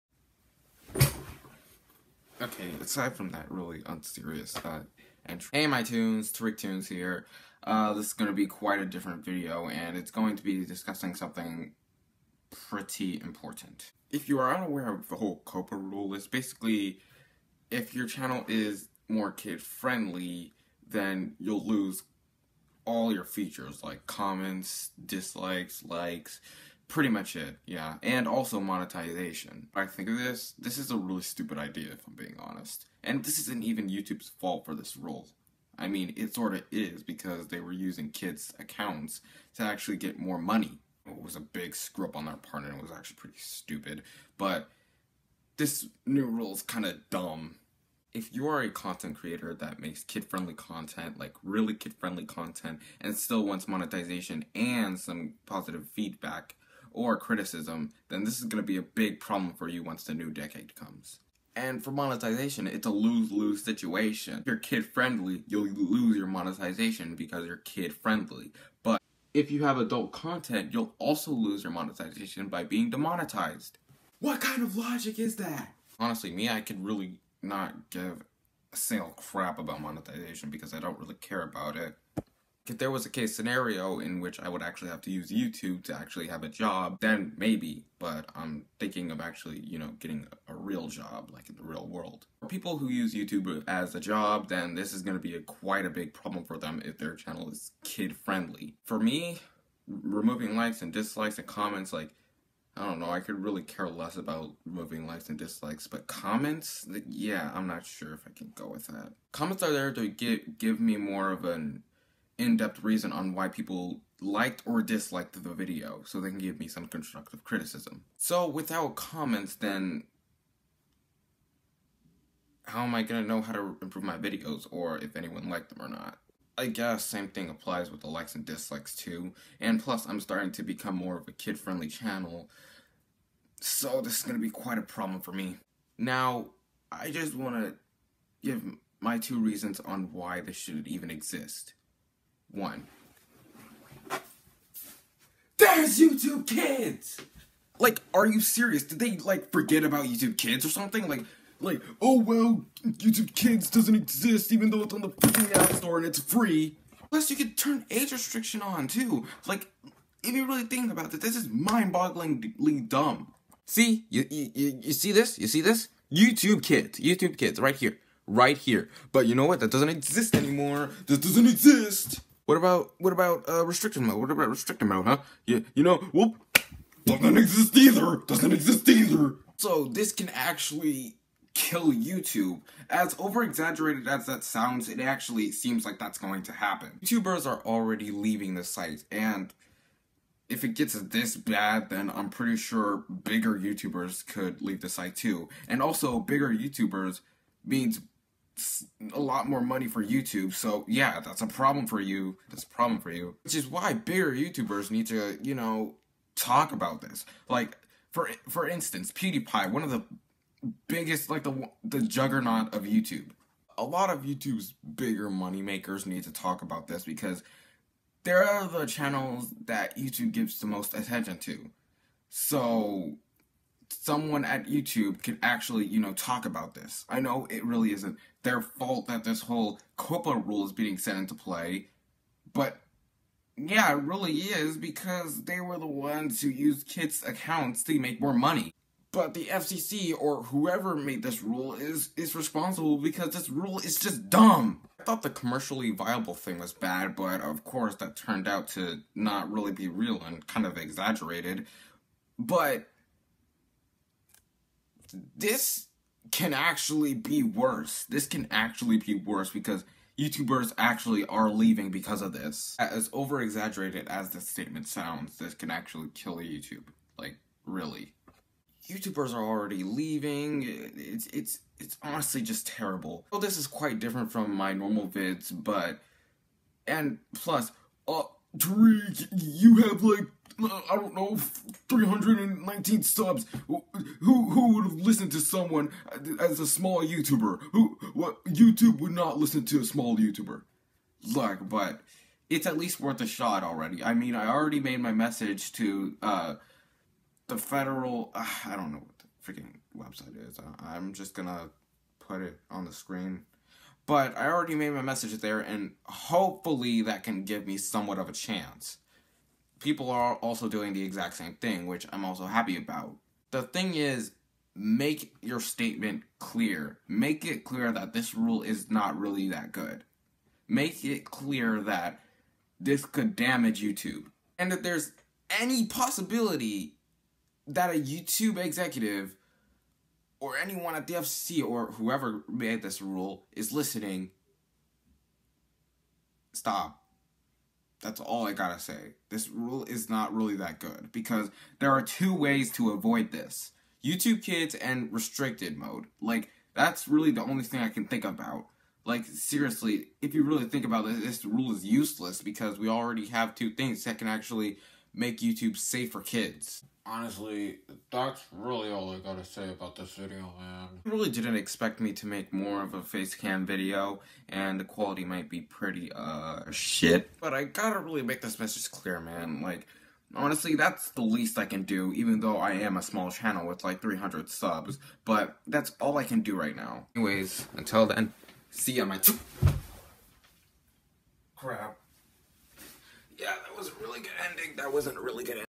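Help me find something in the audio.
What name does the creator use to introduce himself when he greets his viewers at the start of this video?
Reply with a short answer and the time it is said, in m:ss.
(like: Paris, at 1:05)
TariqToons, at 0:06.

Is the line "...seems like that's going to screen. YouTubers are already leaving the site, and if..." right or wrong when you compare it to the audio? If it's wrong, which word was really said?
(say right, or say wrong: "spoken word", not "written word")
wrong: "happen", not "screen".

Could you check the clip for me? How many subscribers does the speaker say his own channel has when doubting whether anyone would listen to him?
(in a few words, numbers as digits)
319.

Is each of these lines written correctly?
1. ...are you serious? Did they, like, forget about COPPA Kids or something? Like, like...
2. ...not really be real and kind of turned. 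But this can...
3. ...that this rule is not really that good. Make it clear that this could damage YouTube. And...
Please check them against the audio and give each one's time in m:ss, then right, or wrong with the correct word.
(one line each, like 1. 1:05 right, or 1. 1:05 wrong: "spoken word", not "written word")
1. 2:28 wrong: "YouTube", not "COPPA"
2. 4:09 wrong: "exaggerated", not "turned"
3. 5:17 right.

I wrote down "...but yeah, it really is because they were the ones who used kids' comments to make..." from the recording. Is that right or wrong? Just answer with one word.
wrong.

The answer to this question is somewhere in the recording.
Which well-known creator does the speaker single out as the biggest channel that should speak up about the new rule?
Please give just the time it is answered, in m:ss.
3:29.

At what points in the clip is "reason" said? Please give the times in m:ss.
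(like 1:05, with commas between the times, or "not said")
1:52, 2:19.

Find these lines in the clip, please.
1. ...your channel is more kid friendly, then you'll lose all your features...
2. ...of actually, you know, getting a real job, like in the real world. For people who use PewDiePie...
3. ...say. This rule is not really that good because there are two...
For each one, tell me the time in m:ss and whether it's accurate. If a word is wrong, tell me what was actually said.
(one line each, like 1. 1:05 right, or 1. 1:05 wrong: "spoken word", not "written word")
1. 0:17 right
2. 1:29 wrong: "YouTube", not "PewDiePie"
3. 5:38 right.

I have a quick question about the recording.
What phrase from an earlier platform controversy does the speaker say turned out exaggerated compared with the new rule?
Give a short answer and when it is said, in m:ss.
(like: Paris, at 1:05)
commercially viable, at 4:05.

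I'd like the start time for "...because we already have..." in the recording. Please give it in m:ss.
5:52.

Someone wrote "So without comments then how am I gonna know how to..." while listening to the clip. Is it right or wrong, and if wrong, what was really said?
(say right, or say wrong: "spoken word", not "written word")
right.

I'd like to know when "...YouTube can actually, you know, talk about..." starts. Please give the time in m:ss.
3:44.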